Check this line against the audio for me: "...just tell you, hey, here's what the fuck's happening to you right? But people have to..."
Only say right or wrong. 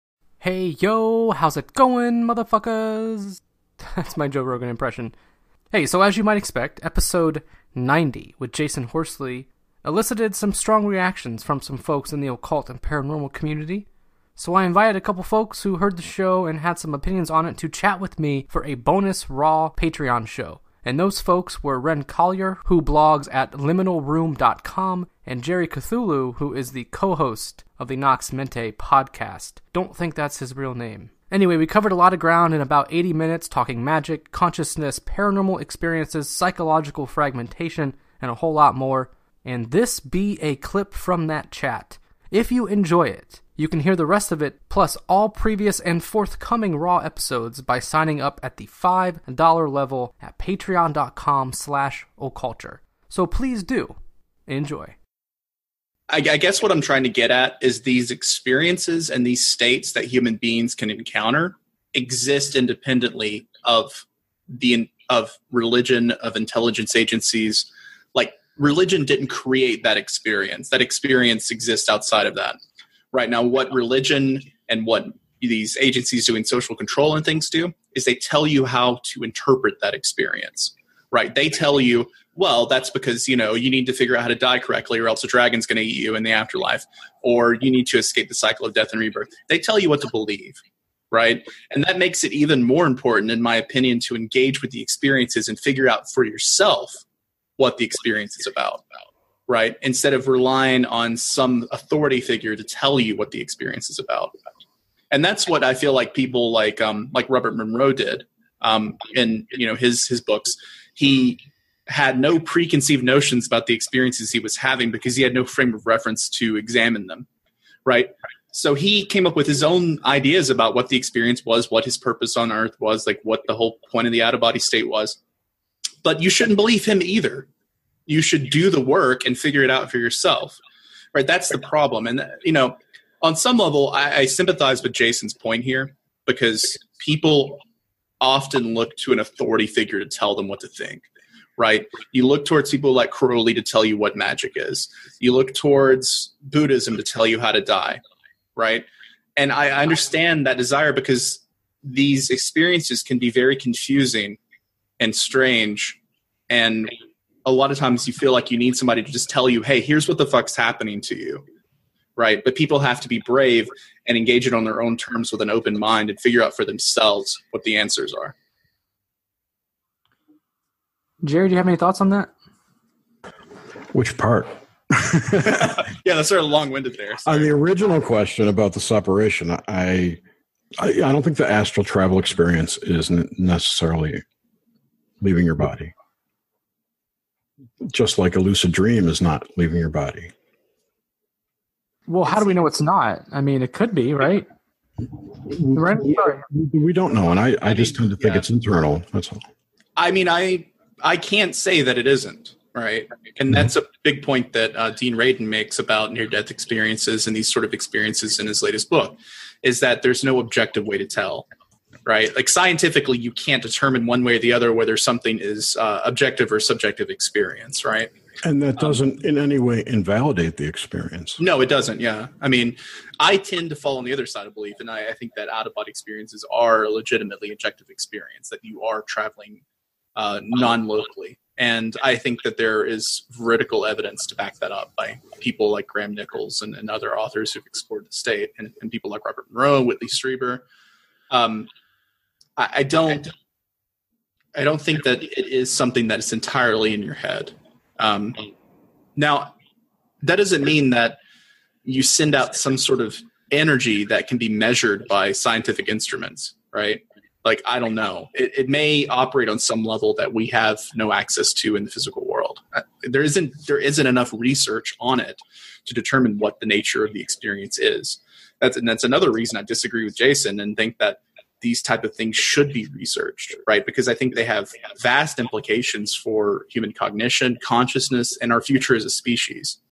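right.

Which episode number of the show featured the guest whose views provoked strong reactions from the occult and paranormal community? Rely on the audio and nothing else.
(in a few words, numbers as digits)
90.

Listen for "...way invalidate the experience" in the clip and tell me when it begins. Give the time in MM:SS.
03:39.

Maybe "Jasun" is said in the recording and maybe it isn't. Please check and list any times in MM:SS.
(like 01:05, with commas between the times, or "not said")
00:08, 02:14, 04:30.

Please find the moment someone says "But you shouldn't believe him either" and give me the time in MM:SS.
02:06.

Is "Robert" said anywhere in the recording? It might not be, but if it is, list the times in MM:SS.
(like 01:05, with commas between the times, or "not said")
01:47, 03:59.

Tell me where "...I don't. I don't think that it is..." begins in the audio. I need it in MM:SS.
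04:02.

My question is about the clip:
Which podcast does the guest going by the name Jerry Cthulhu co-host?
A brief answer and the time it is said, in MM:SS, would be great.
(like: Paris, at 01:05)
Nox Mente, at 00:27.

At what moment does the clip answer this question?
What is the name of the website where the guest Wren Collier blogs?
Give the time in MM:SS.
00:23.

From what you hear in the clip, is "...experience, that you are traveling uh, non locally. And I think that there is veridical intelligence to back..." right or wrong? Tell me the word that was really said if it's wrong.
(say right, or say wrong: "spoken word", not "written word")
wrong: "evidence", not "intelligence".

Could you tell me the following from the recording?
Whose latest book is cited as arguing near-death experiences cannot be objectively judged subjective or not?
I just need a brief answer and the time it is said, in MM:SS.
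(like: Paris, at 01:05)
Dean Radin, at 03:24.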